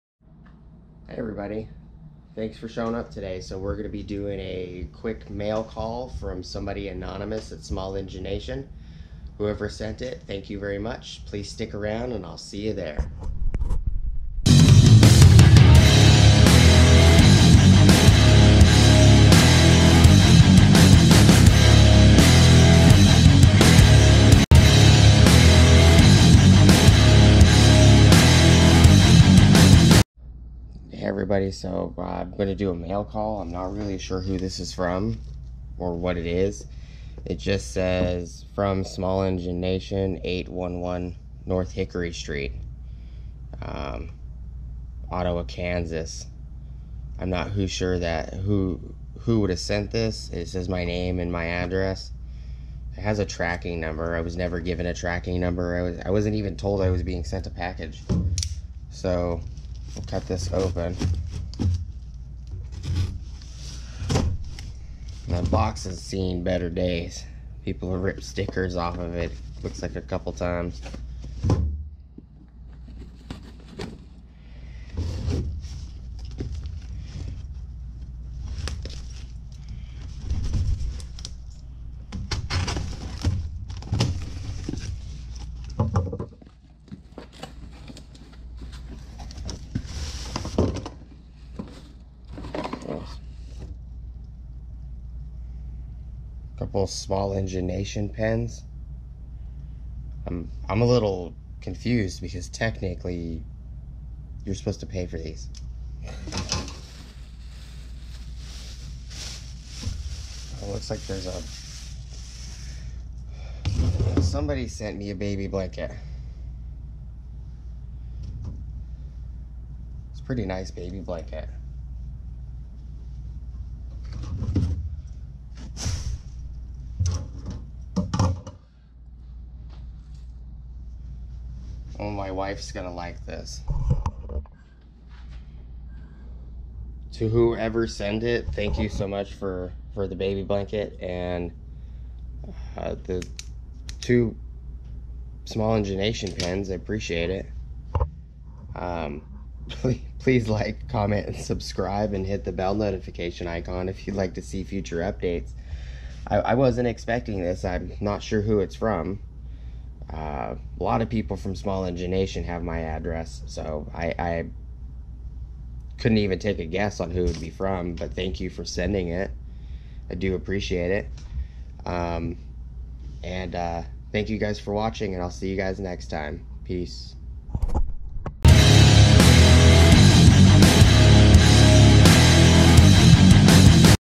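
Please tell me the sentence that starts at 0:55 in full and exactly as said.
I was I wasn't even told I was being sent a package.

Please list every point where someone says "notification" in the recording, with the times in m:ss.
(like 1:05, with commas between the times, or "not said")
2:32.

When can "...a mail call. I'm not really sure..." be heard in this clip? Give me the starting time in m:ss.
0:32.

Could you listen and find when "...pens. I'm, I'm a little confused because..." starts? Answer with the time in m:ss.
1:38.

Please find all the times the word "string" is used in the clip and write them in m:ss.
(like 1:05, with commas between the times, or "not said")
not said.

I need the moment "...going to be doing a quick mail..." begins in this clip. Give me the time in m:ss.
0:03.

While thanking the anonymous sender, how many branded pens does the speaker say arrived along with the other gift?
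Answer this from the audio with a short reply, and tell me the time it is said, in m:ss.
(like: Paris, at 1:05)
2, at 2:24.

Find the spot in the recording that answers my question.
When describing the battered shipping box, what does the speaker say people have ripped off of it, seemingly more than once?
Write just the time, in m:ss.
1:08.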